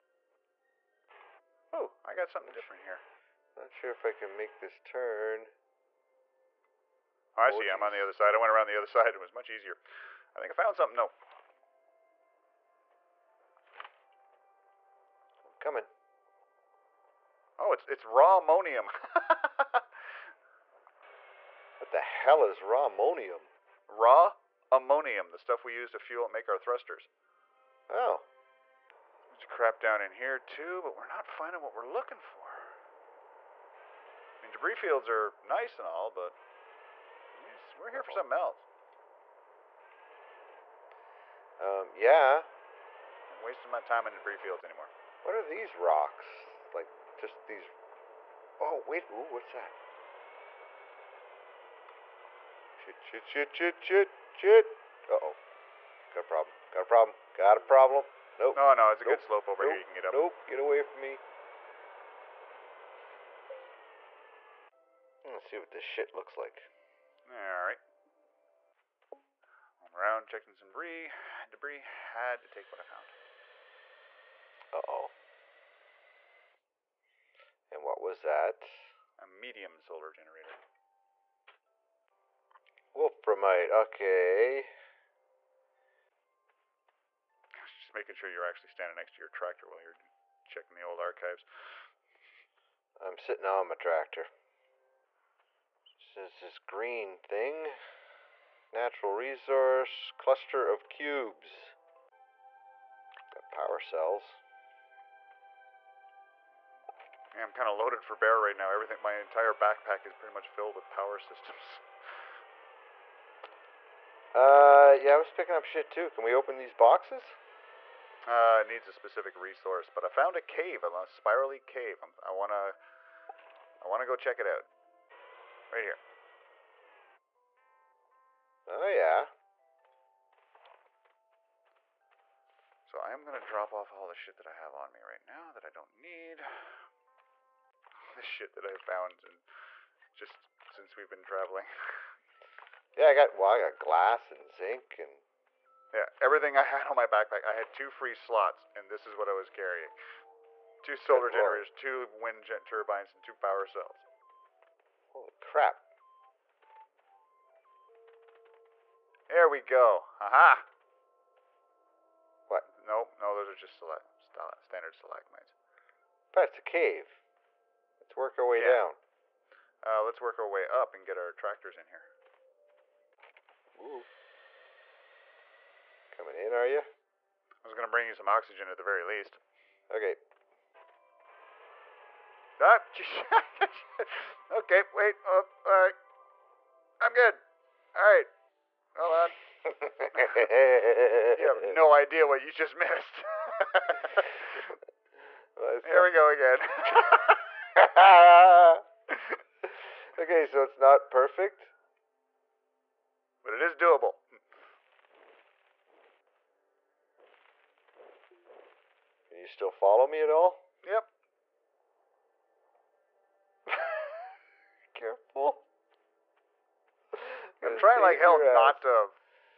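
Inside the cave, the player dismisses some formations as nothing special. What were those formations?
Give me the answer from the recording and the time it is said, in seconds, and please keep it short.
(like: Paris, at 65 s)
Stalagmites, at 164 s.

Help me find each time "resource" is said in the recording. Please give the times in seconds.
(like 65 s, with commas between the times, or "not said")
99 s, 119 s.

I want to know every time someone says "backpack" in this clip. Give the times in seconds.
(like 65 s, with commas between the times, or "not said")
109 s, 147 s.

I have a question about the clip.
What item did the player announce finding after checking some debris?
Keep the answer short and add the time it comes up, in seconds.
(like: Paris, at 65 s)
Medium solar generator, at 79 s.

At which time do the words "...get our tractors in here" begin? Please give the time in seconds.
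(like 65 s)
171 s.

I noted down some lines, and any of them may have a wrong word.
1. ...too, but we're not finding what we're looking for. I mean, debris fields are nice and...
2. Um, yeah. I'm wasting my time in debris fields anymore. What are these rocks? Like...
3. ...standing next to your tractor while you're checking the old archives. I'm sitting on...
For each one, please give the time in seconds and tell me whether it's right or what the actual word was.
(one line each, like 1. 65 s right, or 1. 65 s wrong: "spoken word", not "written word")
1. 30 s right
2. 41 s right
3. 88 s right.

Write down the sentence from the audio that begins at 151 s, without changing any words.
two wind gen- turbines, and two power cells.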